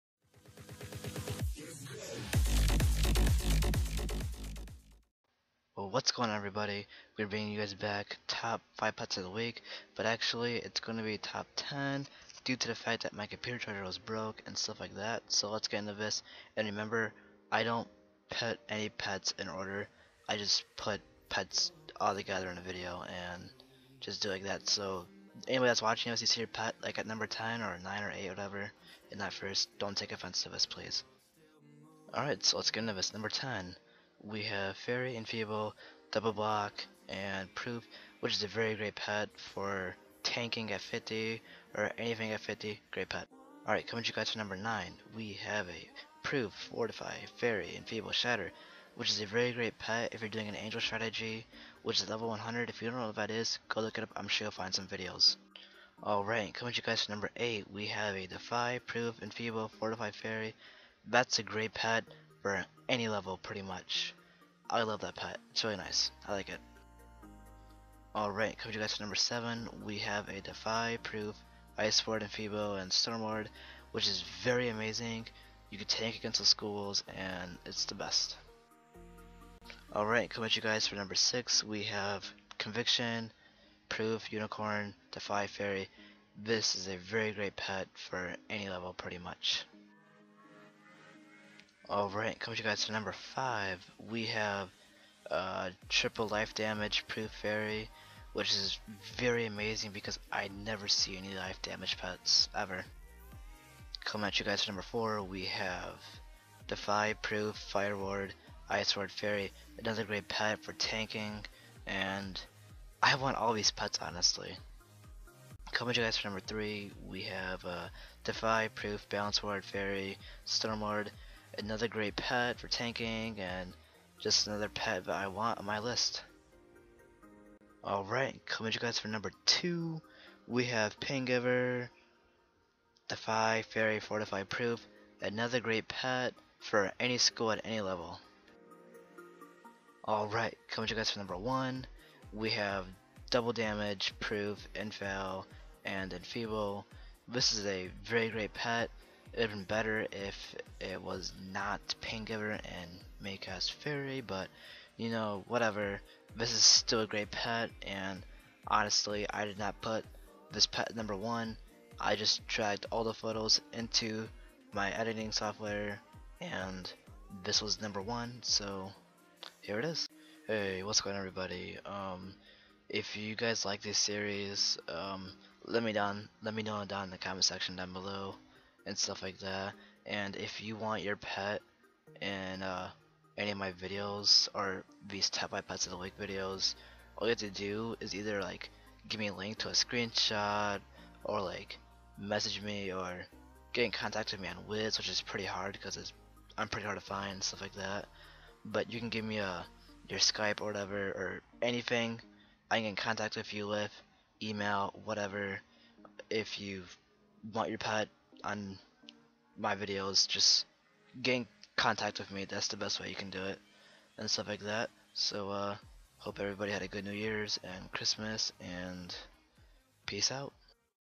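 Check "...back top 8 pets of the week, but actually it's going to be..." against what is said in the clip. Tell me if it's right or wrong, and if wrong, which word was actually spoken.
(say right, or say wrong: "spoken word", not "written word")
wrong: "5", not "8".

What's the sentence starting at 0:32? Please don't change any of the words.
Alright, so let's get into this.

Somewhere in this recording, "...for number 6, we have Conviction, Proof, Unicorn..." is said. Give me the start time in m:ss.
1:20.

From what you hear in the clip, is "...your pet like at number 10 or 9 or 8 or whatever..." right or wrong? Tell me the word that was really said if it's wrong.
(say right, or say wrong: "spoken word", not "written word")
right.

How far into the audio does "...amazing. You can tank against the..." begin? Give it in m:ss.
1:14.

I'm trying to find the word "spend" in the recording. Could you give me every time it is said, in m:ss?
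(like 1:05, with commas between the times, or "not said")
not said.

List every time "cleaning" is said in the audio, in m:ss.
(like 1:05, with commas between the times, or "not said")
not said.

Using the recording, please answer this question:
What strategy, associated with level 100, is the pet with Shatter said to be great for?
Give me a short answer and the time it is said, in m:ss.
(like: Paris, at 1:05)
Angel strategy, at 0:50.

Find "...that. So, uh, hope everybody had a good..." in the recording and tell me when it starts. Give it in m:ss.
3:34.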